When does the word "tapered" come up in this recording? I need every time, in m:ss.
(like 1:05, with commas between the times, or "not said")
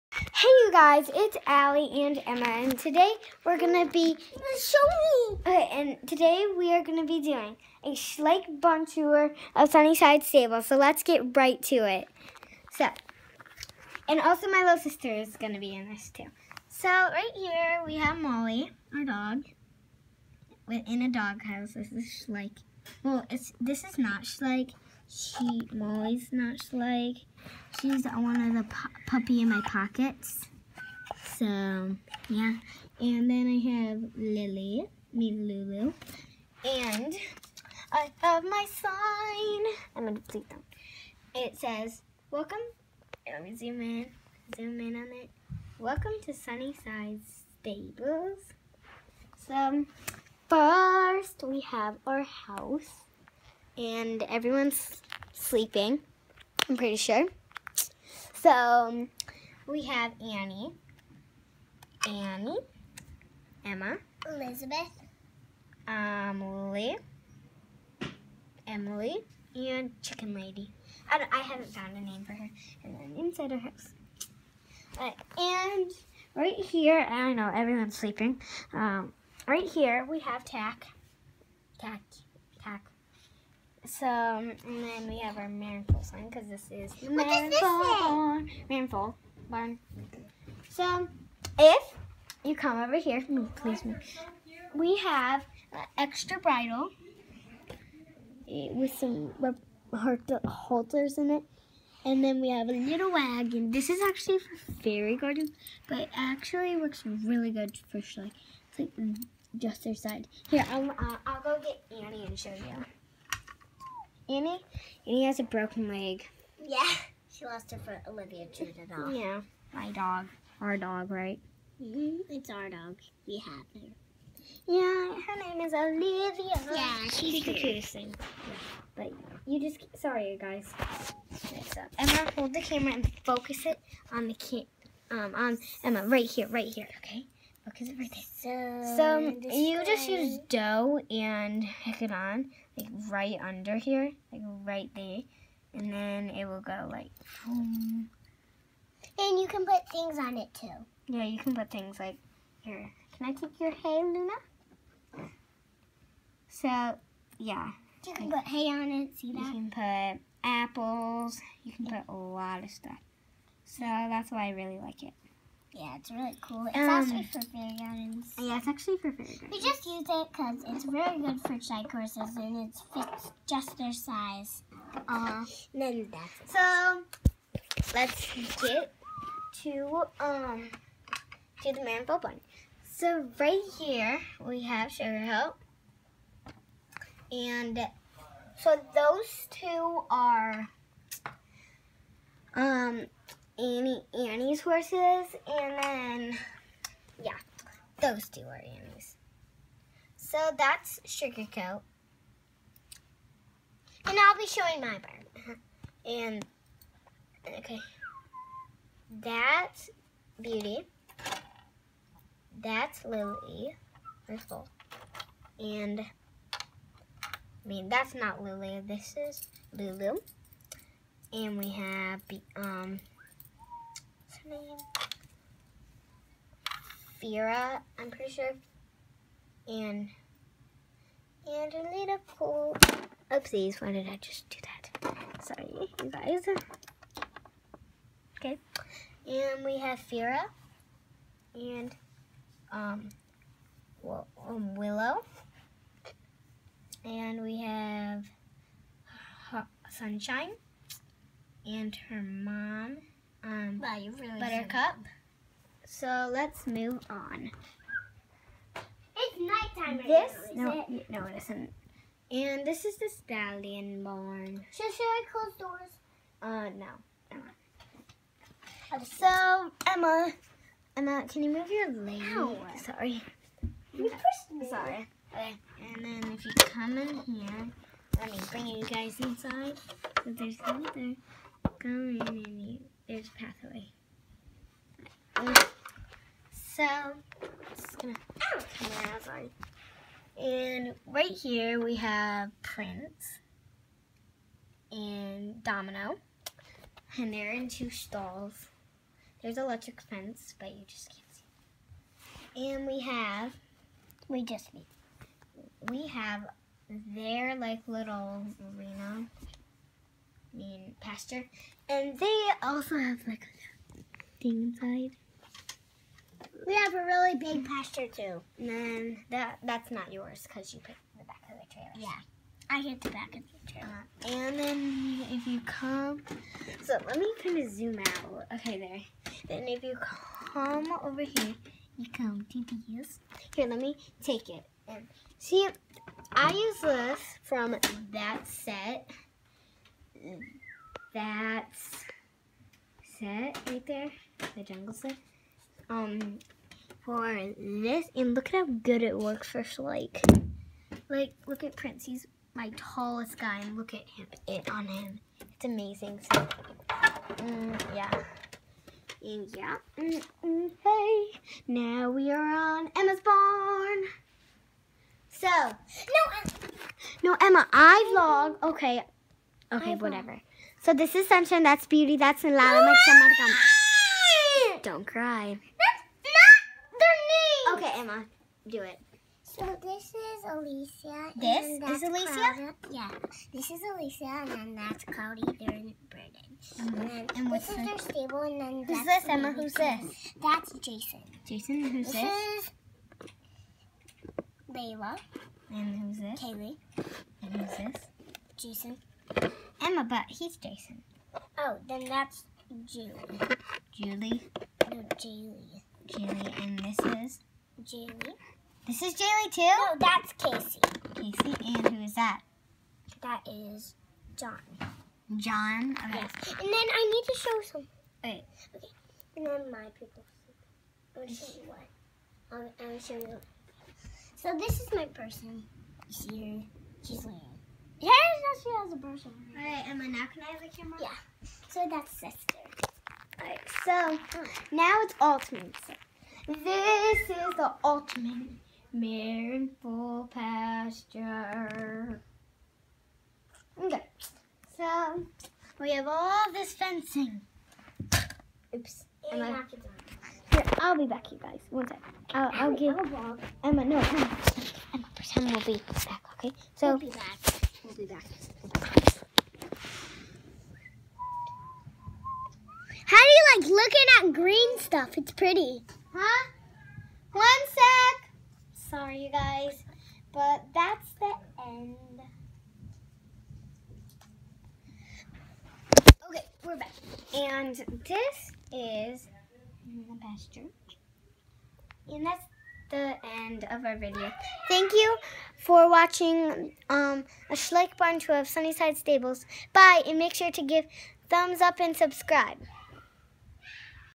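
not said.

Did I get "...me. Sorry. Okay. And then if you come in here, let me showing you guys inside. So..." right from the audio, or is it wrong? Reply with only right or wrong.
wrong.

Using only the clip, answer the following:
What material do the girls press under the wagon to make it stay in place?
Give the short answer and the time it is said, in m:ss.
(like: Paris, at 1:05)
dough, at 2:20.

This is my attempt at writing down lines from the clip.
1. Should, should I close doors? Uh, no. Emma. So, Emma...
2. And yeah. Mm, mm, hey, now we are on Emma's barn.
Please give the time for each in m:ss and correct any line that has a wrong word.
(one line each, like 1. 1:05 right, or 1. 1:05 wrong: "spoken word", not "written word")
1. 4:24 right
2. 5:59 right.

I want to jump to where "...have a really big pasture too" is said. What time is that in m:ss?
5:16.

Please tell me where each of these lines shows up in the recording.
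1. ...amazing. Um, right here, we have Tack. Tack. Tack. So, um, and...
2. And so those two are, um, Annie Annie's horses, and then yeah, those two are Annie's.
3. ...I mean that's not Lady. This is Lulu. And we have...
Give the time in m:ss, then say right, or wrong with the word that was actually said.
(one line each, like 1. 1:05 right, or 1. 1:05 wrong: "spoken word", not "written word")
1. 1:17 wrong: "sleeping", not "amazing"
2. 3:07 right
3. 3:36 wrong: "Lily", not "Lady".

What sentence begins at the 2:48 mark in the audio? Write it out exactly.
Yeah, it's actually for fairy gardens.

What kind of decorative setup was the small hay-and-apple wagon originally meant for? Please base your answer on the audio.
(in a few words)
fairy garden.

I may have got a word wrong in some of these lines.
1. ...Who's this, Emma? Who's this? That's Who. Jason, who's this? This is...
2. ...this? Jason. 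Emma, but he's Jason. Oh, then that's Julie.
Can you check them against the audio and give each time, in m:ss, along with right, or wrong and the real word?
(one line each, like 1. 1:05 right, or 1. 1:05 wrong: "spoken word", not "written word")
1. 6:28 wrong: "Jason", not "Who"
2. 6:37 right.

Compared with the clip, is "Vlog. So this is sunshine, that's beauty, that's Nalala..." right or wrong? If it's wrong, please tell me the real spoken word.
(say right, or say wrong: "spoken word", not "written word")
right.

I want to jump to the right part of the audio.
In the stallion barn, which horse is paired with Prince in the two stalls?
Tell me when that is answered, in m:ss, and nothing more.
4:55.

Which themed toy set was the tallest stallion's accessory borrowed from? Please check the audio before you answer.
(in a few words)
the jungle set.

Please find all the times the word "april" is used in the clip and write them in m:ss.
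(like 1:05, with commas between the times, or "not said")
not said.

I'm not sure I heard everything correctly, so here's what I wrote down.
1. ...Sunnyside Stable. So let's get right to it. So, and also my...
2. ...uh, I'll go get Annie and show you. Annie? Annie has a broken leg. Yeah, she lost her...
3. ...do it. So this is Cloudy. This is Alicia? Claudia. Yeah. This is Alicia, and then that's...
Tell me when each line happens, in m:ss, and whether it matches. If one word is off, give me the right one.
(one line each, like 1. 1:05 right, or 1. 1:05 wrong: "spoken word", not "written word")
1. 0:09 right
2. 1:50 right
3. 6:18 wrong: "Alicia", not "Cloudy".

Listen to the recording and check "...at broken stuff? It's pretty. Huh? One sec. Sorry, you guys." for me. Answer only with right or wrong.
wrong.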